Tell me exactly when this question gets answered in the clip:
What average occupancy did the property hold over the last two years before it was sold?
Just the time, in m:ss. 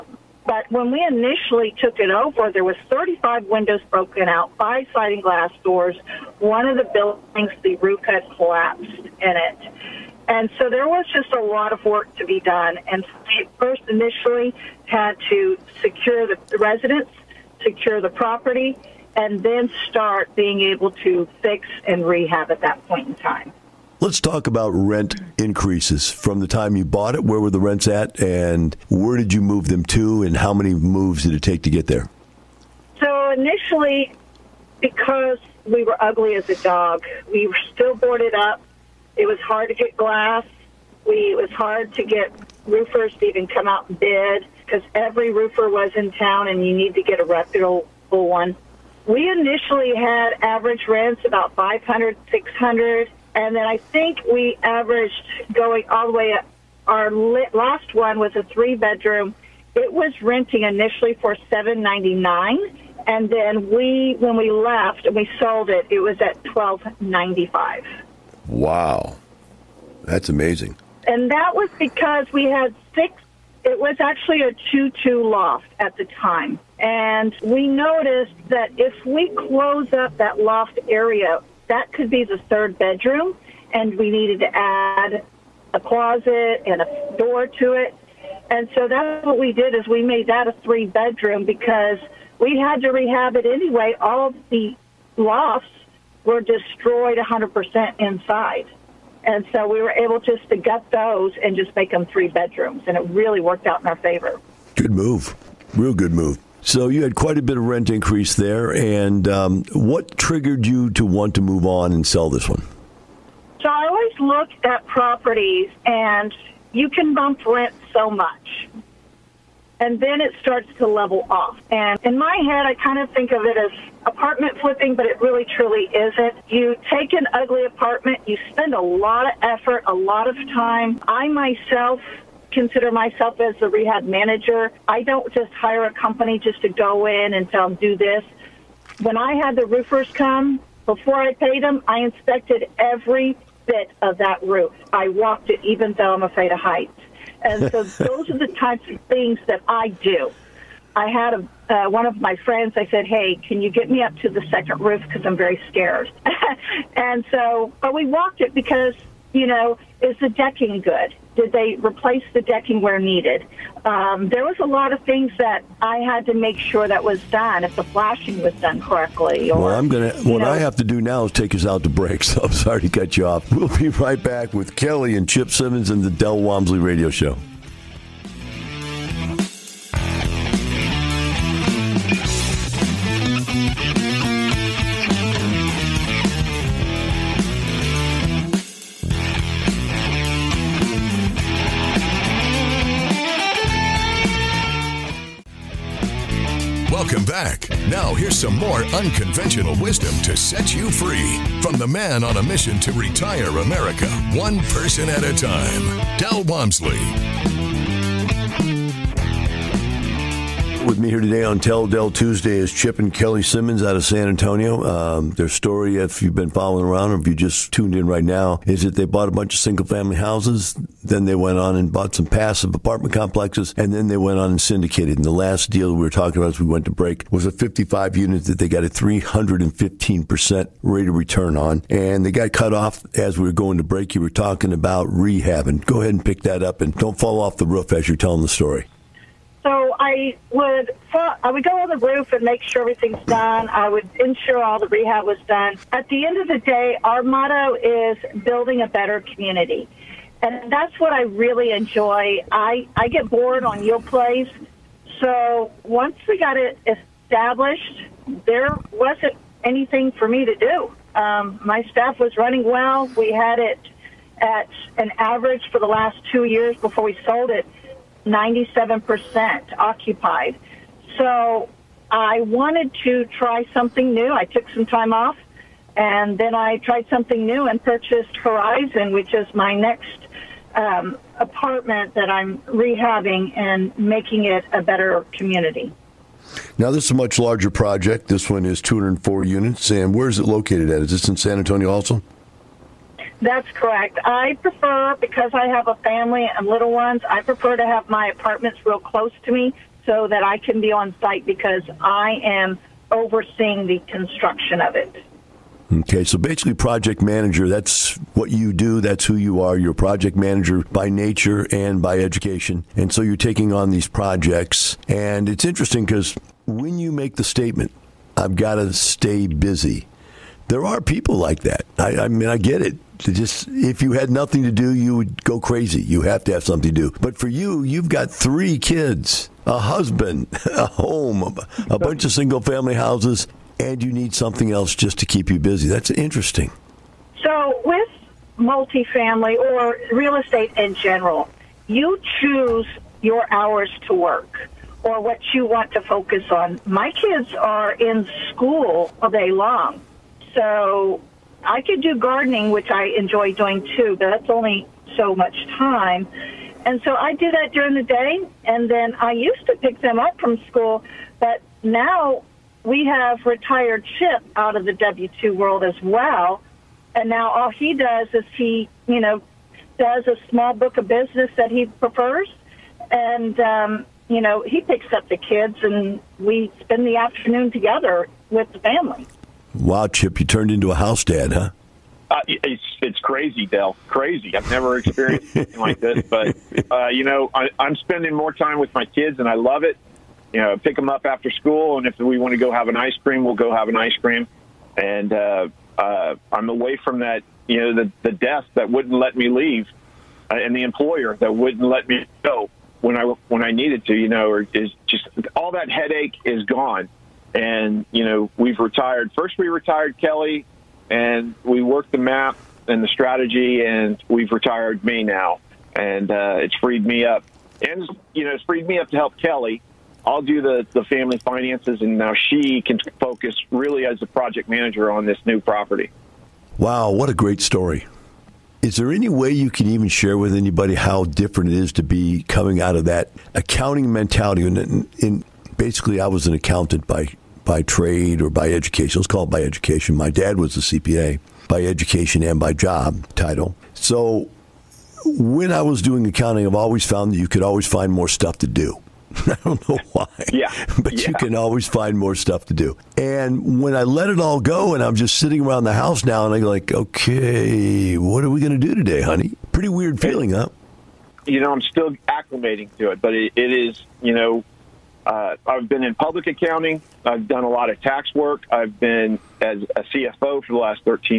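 4:28.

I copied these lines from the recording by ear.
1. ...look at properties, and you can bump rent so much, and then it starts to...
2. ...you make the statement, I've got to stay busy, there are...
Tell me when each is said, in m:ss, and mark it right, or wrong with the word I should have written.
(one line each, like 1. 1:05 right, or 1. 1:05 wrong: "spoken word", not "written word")
1. 1:54 right
2. 5:16 right.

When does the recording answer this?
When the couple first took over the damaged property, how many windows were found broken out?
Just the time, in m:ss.
0:02.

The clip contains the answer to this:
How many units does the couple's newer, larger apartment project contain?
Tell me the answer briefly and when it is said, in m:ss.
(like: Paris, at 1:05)
204, at 4:48.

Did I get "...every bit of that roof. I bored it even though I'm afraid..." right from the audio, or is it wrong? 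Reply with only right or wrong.
wrong.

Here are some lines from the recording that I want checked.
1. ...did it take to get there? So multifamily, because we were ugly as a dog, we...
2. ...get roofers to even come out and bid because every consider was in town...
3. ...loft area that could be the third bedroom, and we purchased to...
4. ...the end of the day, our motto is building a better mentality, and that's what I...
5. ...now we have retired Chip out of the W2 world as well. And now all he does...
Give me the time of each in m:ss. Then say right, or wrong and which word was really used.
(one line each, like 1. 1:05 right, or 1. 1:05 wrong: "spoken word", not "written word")
1. 0:31 wrong: "initially", not "multifamily"
2. 0:42 wrong: "roofer", not "consider"
3. 1:20 wrong: "needed", not "purchased"
4. 4:06 wrong: "community", not "mentality"
5. 6:01 right.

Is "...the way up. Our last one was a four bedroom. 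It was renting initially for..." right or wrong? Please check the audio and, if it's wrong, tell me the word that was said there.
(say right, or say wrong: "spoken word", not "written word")
wrong: "three", not "four".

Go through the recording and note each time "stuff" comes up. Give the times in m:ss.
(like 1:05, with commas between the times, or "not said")
7:28, 7:32.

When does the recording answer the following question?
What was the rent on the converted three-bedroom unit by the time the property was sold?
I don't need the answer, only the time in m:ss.
1:06.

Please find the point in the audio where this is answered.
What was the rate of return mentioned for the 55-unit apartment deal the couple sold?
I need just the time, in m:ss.
3:48.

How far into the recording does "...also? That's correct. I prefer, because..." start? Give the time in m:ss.
4:51.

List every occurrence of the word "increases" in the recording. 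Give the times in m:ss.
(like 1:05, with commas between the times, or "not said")
0:25, 1:47.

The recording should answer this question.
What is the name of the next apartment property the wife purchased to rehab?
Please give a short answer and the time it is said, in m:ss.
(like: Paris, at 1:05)
Horizon, at 4:38.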